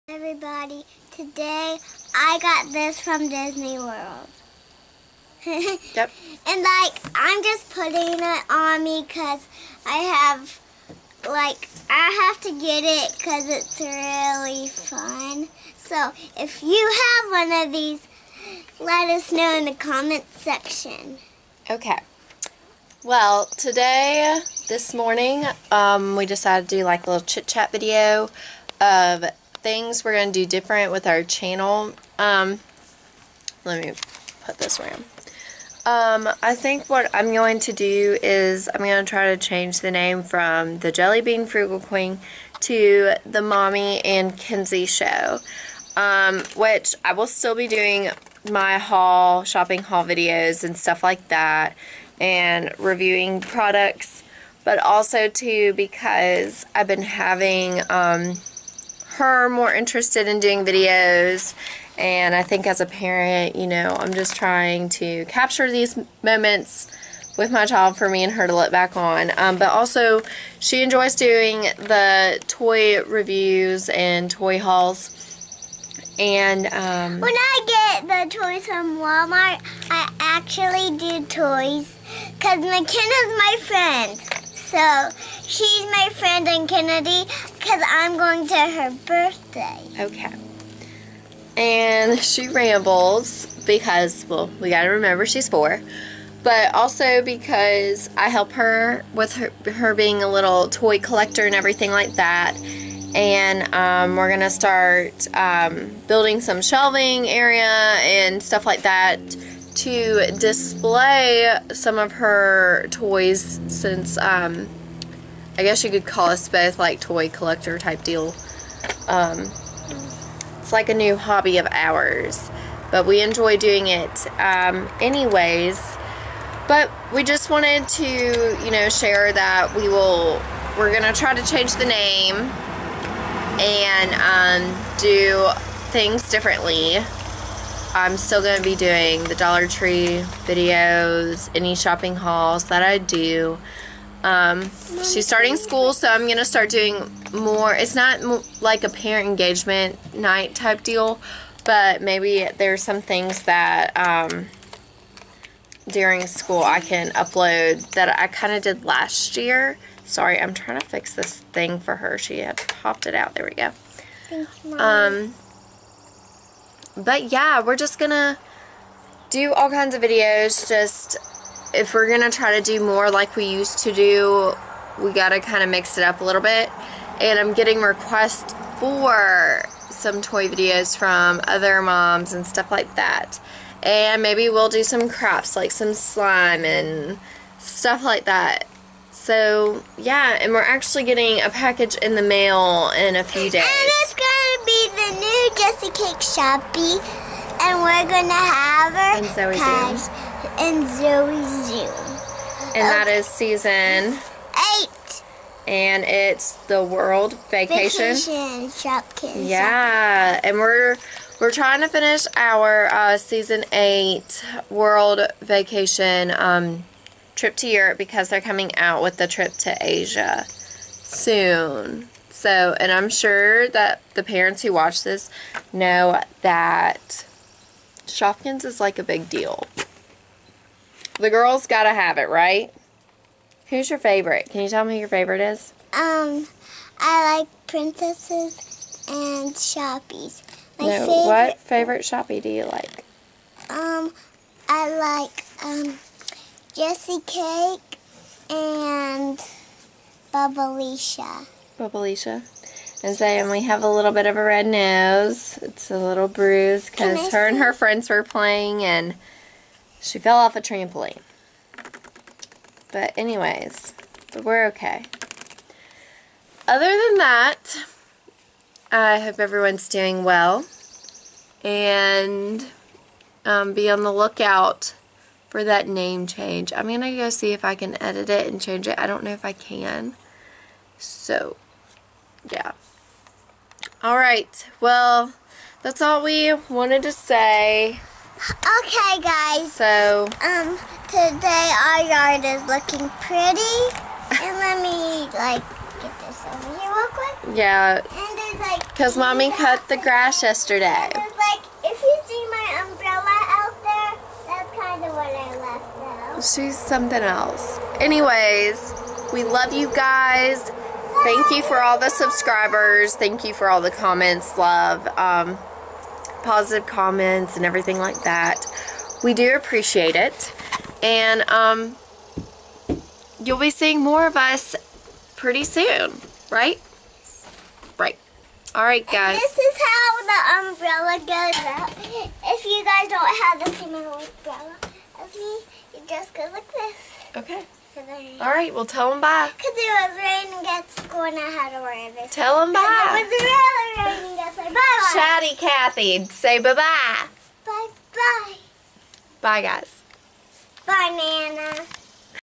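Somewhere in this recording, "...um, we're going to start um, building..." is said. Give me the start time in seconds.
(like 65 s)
103 s.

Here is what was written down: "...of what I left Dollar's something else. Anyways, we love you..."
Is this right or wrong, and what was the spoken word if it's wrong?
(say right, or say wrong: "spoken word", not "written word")
wrong: "She", not "Dollar".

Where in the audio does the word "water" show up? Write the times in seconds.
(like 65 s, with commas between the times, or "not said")
not said.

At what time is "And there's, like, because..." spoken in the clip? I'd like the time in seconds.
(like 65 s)
297 s.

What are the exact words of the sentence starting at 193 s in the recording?
And it's gonna be the new Jessicake Shoppy, and we're gonna have her.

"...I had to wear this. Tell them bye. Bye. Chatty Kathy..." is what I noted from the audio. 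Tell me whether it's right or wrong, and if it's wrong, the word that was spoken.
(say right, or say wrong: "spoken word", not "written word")
right.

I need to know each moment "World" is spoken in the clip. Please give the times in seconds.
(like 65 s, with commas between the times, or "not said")
3 s, 206 s, 214 s.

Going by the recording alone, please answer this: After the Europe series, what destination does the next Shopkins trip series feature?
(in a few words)
Asia.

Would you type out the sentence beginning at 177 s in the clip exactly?
And I'm getting requests for some toy videos from other moms and stuff like that.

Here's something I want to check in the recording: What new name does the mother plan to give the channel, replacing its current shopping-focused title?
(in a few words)
the Mommy and Kenzie Show.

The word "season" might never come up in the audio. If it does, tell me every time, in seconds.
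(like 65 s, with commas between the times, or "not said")
203 s, 213 s.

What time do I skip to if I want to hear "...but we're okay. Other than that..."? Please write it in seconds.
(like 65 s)
264 s.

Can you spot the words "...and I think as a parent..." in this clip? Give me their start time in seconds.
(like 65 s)
61 s.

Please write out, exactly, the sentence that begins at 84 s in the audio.
So she's my friend and Kennedy, because I'm going to her birthday.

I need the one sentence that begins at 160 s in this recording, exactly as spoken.
Sorry, I'm trying to fix this thing for her.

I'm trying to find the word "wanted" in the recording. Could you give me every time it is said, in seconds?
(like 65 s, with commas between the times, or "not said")
127 s, 286 s.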